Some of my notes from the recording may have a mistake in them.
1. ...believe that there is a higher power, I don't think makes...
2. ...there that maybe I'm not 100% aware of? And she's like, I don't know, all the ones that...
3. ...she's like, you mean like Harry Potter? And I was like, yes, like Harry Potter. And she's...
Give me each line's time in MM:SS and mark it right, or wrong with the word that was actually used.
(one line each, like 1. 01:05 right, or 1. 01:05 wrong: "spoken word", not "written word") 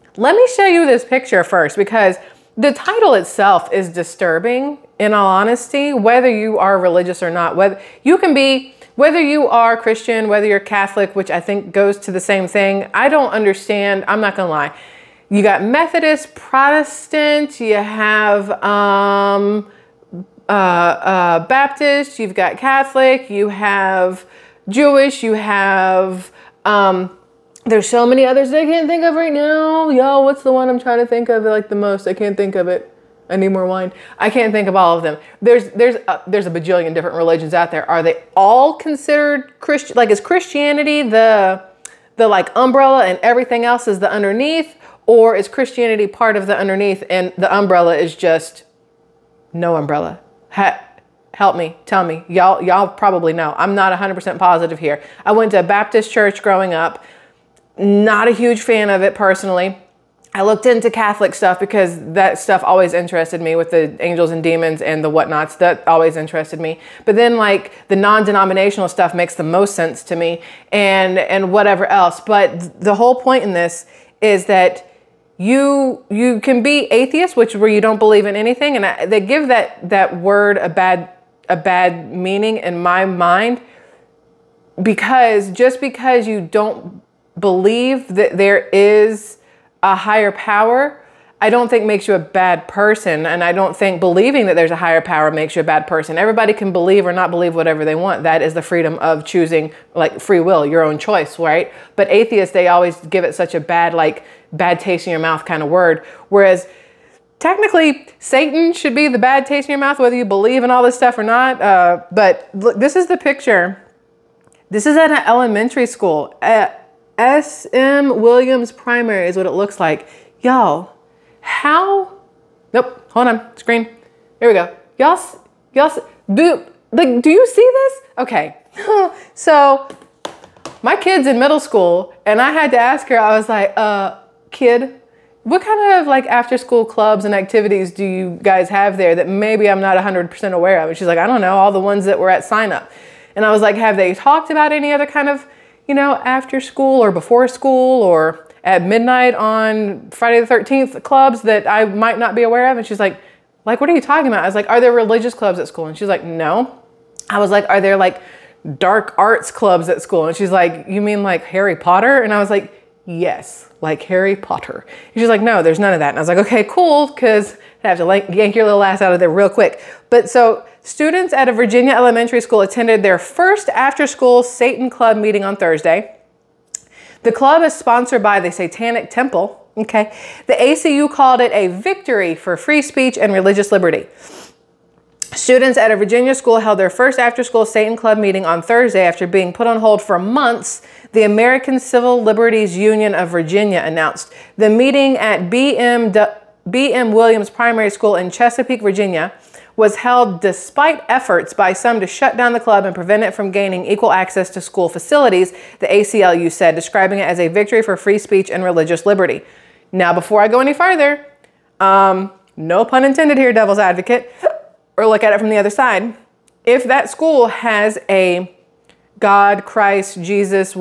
1. 01:27 right
2. 02:18 right
3. 02:40 right.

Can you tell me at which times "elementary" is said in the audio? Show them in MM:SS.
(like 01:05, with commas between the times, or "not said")
01:55, 02:51.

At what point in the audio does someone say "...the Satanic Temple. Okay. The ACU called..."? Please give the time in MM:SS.
02:58.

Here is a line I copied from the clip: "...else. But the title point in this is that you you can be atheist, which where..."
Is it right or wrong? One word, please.
wrong.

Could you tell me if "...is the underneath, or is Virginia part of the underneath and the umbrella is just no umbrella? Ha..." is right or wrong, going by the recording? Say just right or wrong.
wrong.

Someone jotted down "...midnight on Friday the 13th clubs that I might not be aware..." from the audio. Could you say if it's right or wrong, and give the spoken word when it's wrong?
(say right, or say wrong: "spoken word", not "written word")
right.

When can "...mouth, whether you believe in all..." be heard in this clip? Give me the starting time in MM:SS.
01:49.